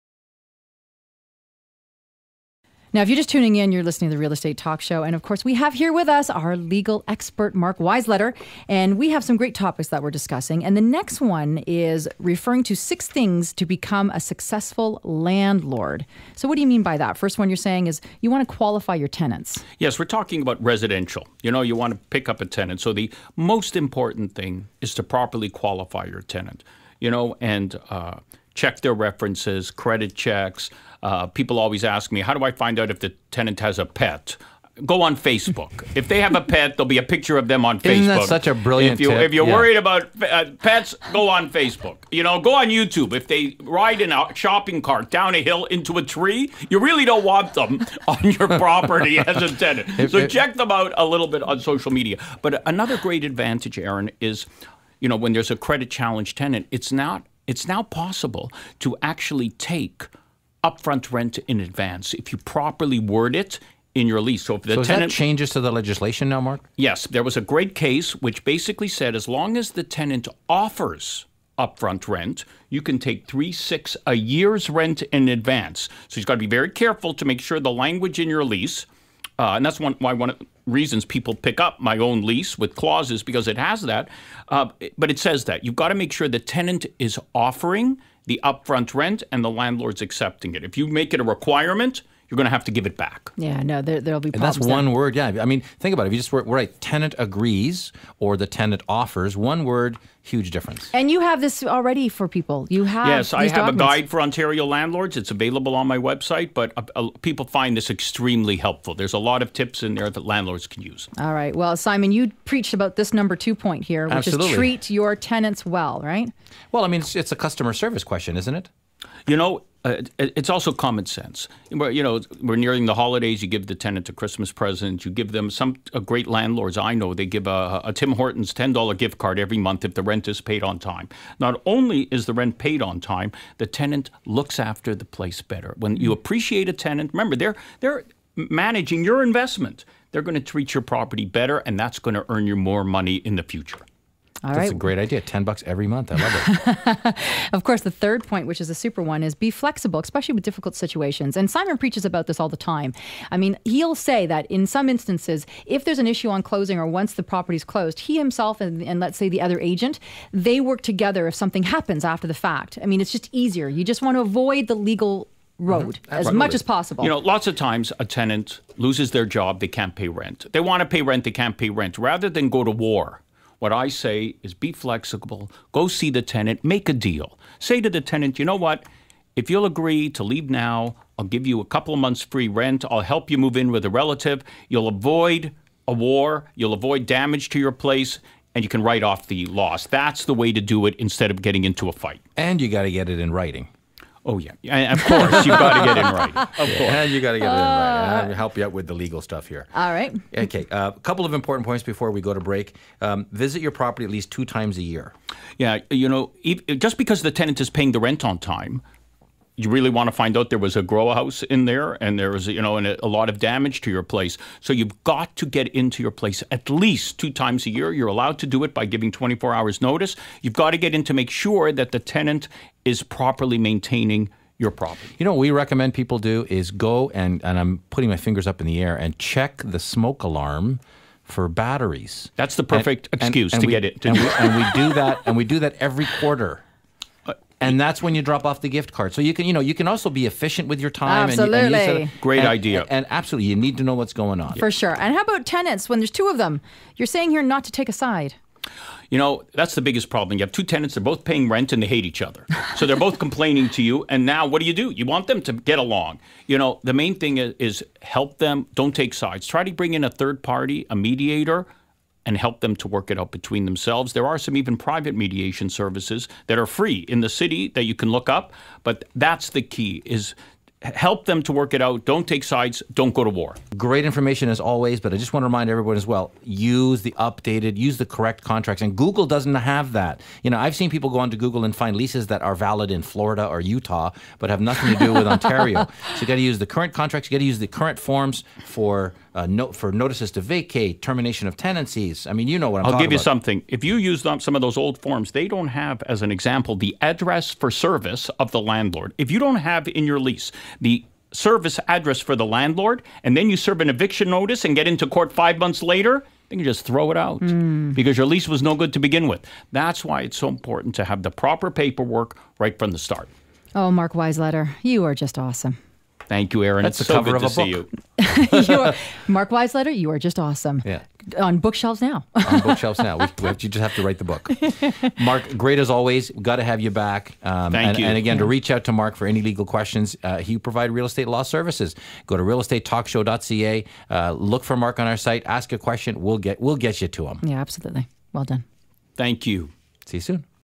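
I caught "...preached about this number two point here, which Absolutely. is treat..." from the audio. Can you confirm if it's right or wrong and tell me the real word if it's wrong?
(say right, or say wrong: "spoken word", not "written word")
right.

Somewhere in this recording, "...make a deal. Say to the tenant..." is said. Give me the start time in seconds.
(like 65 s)
176 s.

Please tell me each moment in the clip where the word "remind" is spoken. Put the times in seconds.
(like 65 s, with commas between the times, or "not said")
275 s.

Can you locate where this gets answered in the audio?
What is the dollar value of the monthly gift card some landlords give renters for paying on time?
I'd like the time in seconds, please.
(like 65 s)
128 s.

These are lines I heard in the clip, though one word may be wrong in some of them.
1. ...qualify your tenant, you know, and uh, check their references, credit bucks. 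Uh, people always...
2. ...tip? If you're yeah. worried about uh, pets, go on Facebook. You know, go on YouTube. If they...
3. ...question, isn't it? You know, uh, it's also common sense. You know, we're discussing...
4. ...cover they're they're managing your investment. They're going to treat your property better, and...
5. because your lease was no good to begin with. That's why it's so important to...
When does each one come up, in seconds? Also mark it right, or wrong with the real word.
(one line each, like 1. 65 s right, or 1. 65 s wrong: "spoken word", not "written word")
1. 25 s wrong: "checks", not "bucks"
2. 39 s right
3. 118 s wrong: "nearing", not "discussing"
4. 137 s wrong: "remember", not "cover"
5. 307 s right.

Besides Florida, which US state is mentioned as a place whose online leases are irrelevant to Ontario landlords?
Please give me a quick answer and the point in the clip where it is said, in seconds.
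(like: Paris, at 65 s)
Utah, at 283 s.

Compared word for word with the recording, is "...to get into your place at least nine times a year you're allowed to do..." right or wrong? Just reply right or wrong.
wrong.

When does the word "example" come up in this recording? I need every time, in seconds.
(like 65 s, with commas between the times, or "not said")
296 s.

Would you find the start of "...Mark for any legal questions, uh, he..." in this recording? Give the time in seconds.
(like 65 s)
328 s.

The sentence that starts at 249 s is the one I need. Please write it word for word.
You know, that's the biggest problem.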